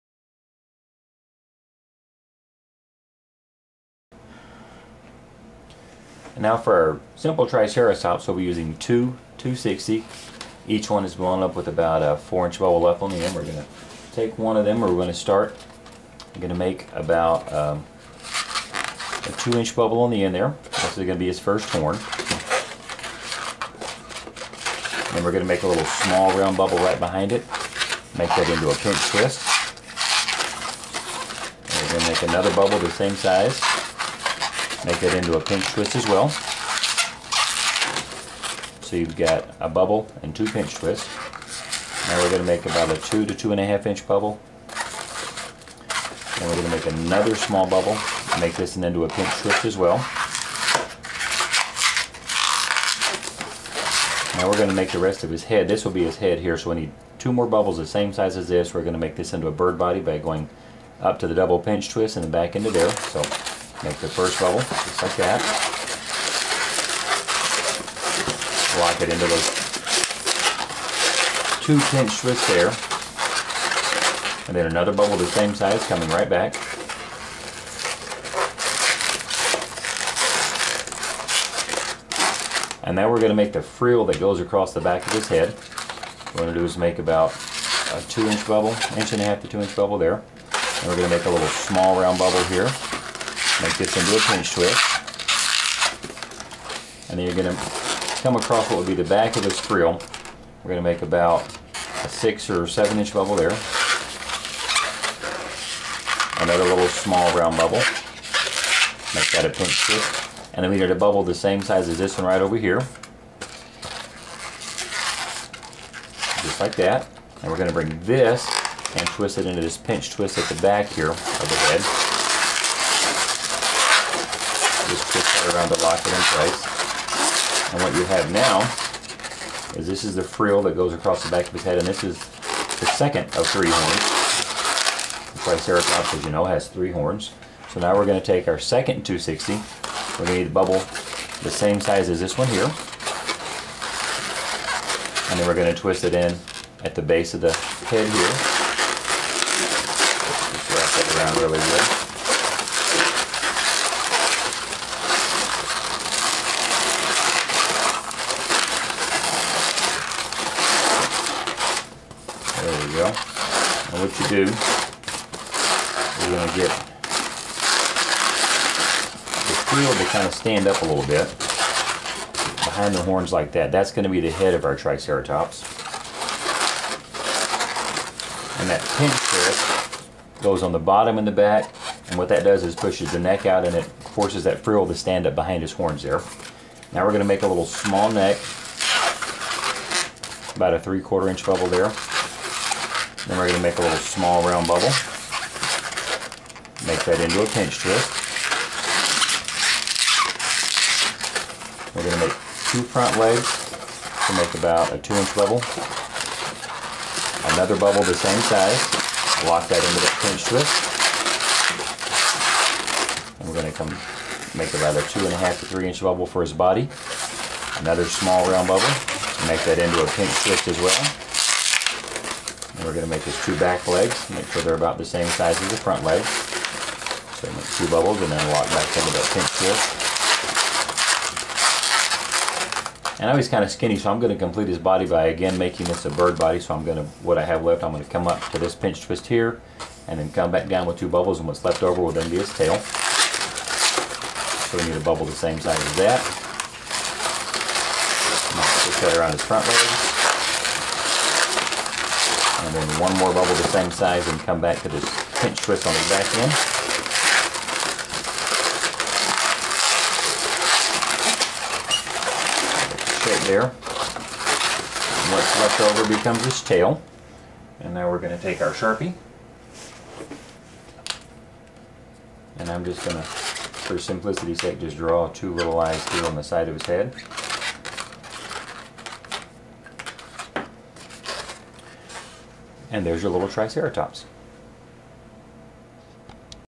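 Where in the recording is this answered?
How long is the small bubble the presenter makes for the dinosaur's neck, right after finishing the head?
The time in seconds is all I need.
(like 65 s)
190 s.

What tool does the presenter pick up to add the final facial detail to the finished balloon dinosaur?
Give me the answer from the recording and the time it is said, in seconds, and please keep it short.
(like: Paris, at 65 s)
Sharpie, at 268 s.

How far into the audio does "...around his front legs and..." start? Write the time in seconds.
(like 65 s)
249 s.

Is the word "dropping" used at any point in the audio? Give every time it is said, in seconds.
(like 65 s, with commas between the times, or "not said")
not said.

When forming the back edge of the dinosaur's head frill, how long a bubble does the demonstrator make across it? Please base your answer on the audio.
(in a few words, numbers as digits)
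6 or 7 inches.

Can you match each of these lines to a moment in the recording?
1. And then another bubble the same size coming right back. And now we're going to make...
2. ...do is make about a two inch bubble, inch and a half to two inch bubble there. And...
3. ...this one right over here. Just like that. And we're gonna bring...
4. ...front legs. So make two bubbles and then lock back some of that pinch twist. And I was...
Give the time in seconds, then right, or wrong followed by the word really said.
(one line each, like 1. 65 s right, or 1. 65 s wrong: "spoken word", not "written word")
1. 74 s right
2. 86 s right
3. 111 s right
4. 225 s right.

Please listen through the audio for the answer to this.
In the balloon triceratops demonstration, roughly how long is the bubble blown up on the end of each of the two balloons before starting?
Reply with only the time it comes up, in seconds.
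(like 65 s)
12 s.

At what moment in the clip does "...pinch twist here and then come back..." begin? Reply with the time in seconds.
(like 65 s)
238 s.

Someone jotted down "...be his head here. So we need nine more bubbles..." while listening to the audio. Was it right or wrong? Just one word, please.
wrong.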